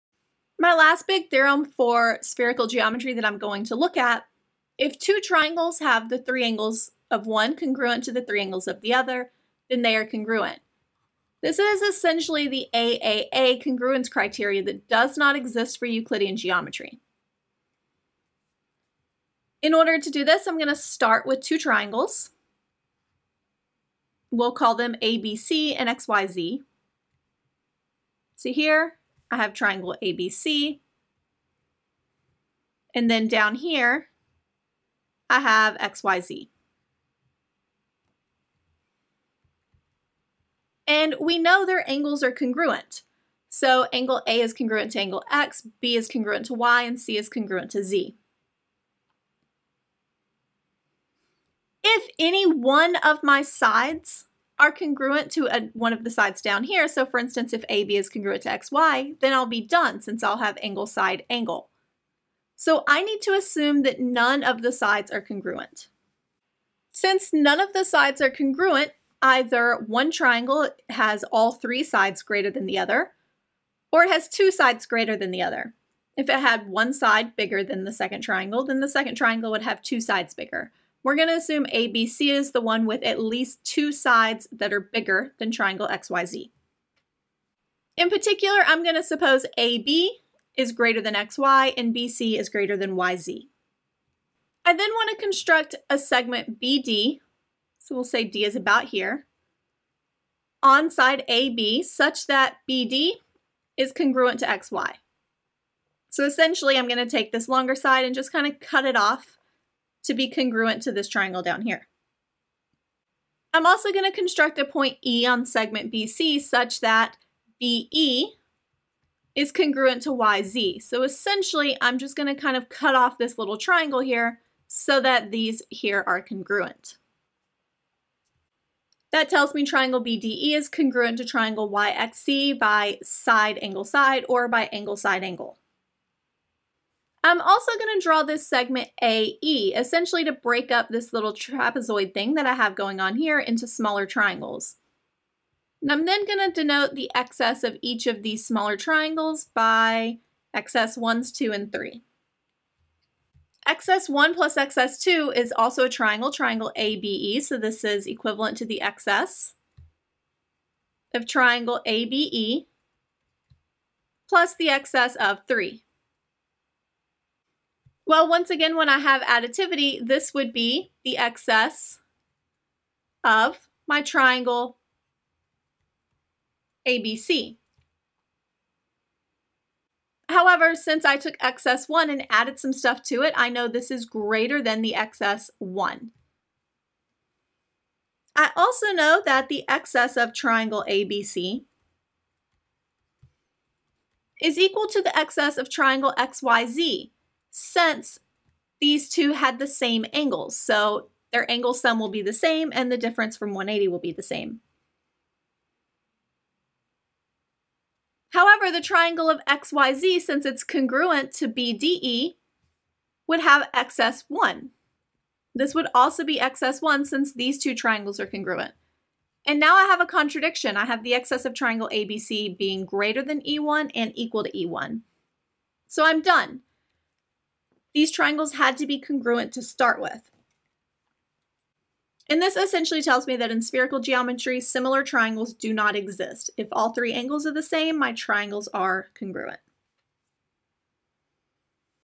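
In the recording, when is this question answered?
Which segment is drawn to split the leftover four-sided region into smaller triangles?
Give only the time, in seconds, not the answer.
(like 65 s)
139 s.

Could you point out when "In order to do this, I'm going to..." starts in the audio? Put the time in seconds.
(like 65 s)
19 s.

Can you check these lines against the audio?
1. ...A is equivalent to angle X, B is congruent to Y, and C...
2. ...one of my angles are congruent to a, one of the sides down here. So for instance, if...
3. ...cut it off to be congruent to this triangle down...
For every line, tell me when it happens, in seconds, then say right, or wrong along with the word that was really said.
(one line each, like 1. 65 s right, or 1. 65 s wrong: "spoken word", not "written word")
1. 44 s wrong: "congruent", not "equivalent"
2. 52 s wrong: "sides", not "angles"
3. 108 s right.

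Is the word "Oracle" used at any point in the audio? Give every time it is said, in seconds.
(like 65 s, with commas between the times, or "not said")
not said.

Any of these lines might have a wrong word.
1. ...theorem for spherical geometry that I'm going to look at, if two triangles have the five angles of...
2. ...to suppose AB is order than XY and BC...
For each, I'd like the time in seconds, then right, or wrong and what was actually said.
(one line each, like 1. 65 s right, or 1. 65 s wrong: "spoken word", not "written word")
1. 1 s wrong: "three", not "five"
2. 88 s wrong: "greater", not "order".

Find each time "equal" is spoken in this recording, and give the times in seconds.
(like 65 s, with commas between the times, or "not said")
194 s, 224 s.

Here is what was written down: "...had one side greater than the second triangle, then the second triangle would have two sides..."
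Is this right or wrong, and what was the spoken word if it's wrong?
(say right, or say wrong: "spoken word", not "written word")
wrong: "bigger", not "greater".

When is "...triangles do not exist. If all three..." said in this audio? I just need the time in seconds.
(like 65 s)
235 s.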